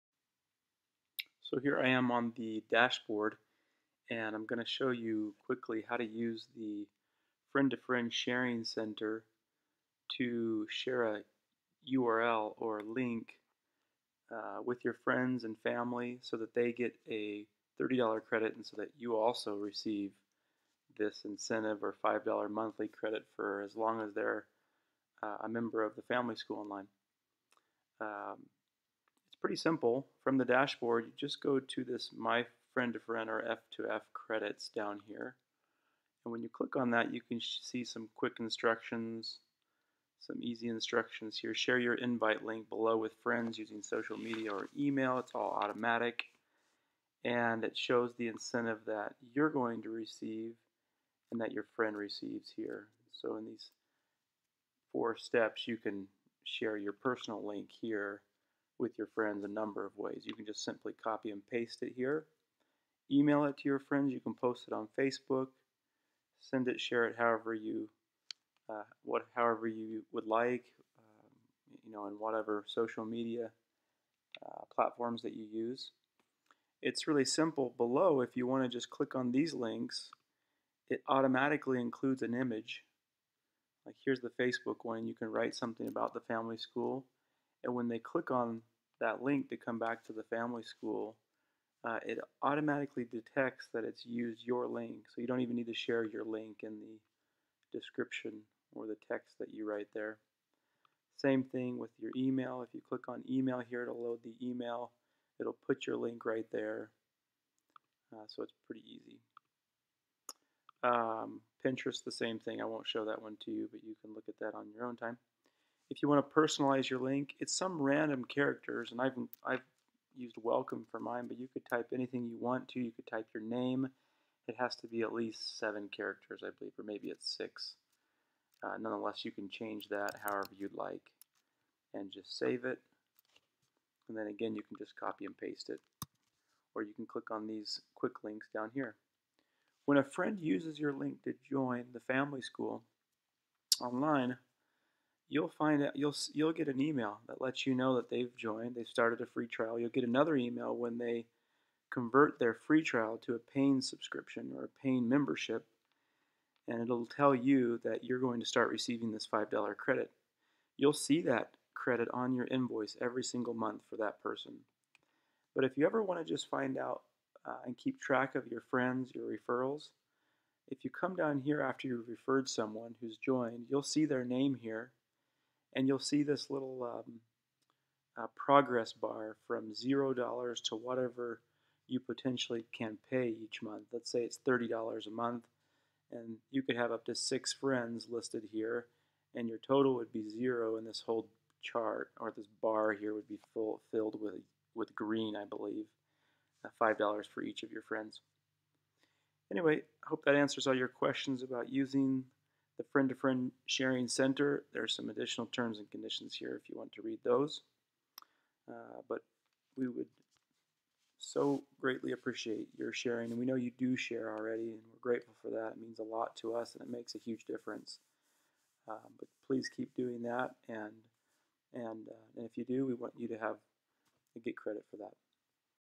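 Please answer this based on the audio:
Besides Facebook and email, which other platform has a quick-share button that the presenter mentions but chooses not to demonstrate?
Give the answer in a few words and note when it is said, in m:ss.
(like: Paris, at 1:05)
Pinterest, at 1:51.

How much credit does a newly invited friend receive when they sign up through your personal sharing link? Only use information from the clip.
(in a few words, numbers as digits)
$30.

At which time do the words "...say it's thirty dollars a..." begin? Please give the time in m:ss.
3:04.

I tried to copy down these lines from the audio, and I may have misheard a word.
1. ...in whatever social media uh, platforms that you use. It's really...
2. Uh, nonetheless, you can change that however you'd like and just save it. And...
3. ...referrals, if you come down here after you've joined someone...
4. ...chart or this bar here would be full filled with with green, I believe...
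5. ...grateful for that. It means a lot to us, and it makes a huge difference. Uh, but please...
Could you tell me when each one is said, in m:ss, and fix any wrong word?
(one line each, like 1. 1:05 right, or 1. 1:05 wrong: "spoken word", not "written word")
1. 1:12 right
2. 2:08 right
3. 2:49 wrong: "referred", not "joined"
4. 3:11 right
5. 3:35 right.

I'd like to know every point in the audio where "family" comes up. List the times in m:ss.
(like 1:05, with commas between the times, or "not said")
0:15, 0:26, 1:26, 1:30, 2:22.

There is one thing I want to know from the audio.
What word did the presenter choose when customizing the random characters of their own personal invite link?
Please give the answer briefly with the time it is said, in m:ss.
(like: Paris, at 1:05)
welcome, at 2:00.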